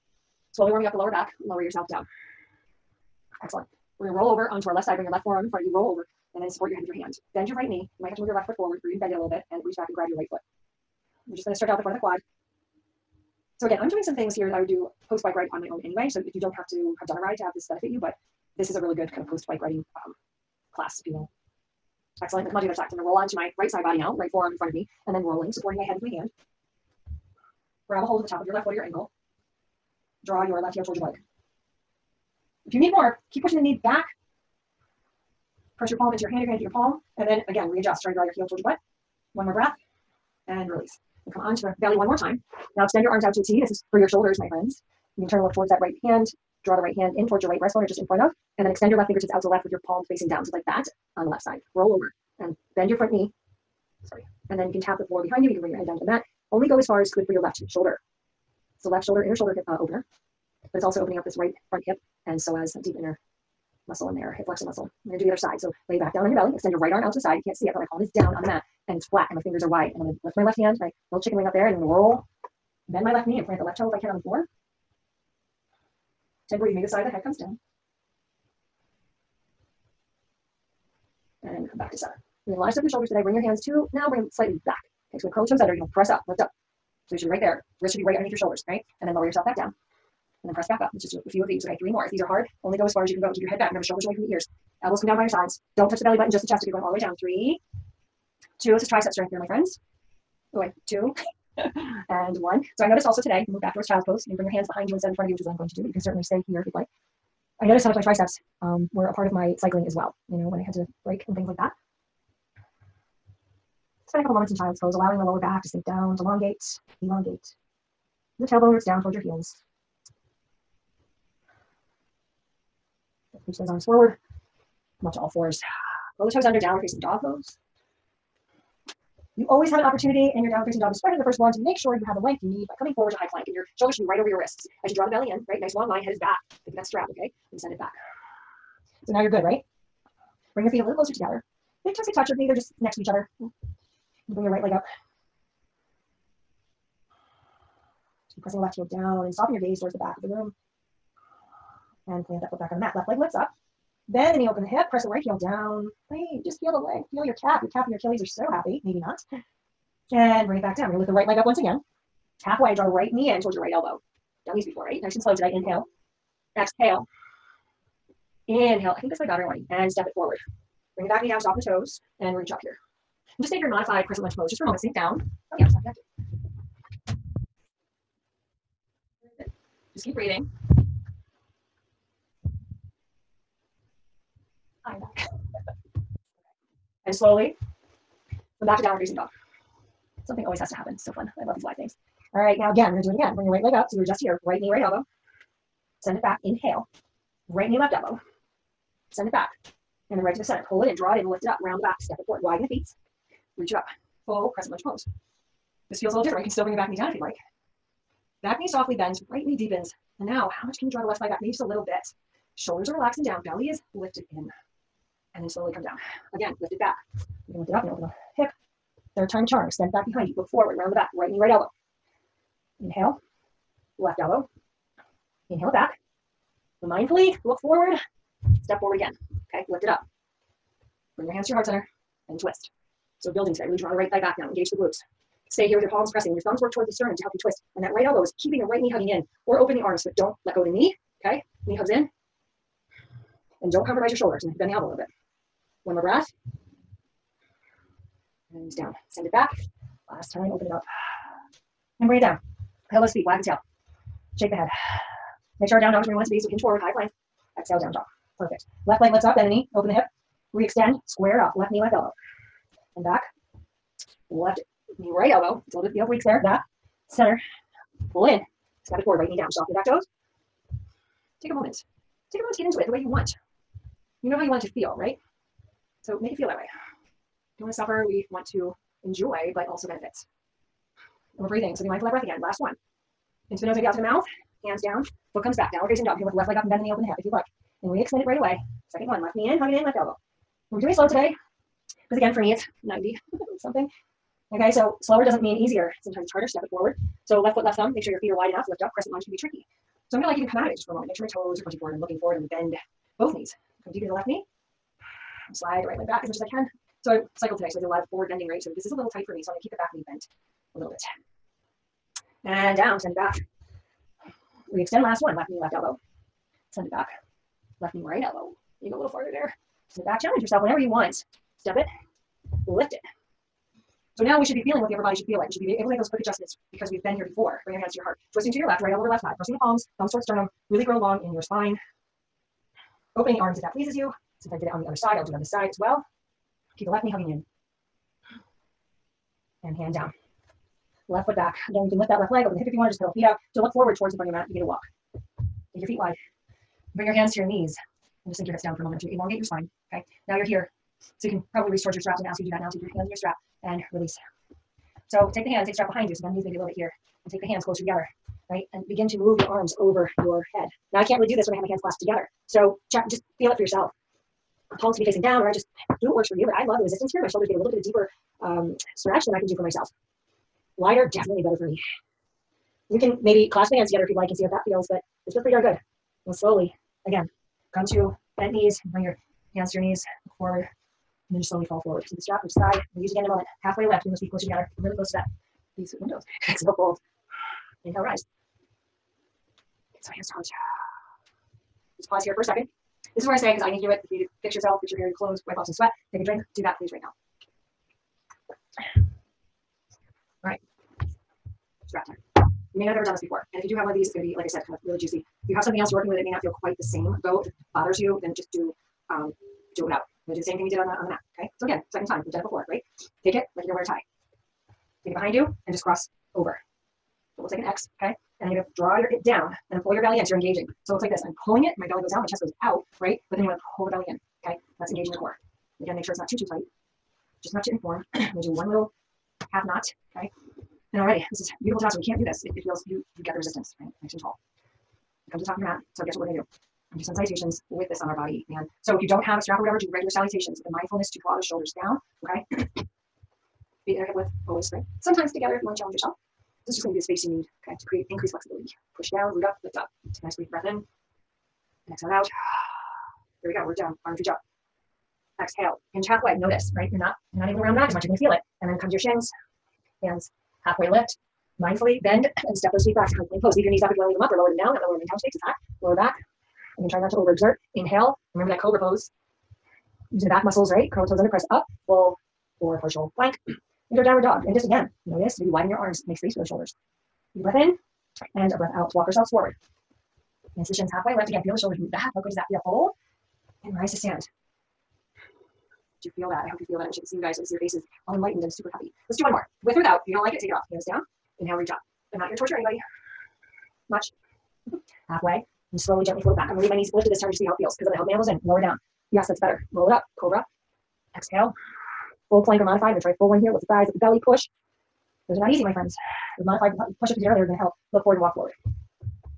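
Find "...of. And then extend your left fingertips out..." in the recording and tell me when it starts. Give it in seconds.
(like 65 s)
48 s.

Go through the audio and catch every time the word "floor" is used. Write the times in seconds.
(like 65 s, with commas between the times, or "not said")
55 s, 74 s.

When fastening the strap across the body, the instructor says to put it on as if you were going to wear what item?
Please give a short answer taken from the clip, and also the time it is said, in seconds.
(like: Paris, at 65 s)
a tie, at 413 s.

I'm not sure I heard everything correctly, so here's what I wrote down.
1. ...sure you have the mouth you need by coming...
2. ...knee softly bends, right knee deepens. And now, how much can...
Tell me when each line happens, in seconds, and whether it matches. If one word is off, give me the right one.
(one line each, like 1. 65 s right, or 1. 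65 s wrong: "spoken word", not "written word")
1. 131 s wrong: "length", not "mouth"
2. 208 s right.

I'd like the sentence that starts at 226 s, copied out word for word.
Mindfully look forward, step forward again.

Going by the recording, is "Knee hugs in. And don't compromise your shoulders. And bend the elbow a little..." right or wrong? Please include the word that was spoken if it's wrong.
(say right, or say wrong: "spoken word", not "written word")
right.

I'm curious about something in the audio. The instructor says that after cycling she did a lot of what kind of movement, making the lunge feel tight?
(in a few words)
forward bending.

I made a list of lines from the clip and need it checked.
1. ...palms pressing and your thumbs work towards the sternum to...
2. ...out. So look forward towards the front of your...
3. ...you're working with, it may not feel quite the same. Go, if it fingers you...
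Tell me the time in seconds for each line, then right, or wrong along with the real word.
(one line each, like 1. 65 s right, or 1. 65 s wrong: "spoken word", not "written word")
1. 235 s right
2. 343 s right
3. 405 s wrong: "bothers", not "fingers".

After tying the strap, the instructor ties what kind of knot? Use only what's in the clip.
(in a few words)
half knot.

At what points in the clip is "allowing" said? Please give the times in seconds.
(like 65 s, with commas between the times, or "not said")
114 s.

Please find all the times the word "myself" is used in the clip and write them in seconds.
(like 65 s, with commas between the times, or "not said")
369 s.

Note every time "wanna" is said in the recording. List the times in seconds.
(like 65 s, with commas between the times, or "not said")
423 s, 445 s.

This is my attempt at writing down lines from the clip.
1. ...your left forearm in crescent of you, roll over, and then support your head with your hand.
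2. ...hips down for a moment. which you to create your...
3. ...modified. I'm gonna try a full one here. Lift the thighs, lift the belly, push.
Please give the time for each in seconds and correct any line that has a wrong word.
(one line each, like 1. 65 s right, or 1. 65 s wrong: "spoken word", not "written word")
1. 5 s wrong: "front", not "crescent"
2. 348 s wrong: "elongate", not "create"
3. 502 s right.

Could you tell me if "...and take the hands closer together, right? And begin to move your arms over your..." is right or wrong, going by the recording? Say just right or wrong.
right.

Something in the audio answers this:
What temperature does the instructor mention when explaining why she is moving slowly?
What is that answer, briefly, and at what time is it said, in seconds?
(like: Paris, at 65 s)
90, at 292 s.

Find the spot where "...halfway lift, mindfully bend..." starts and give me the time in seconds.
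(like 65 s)
460 s.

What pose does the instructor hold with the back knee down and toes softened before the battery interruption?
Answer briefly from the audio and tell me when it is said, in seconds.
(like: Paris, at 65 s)
modified crescent lunge, at 173 s.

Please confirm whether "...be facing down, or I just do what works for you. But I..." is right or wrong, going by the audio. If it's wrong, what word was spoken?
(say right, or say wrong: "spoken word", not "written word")
right.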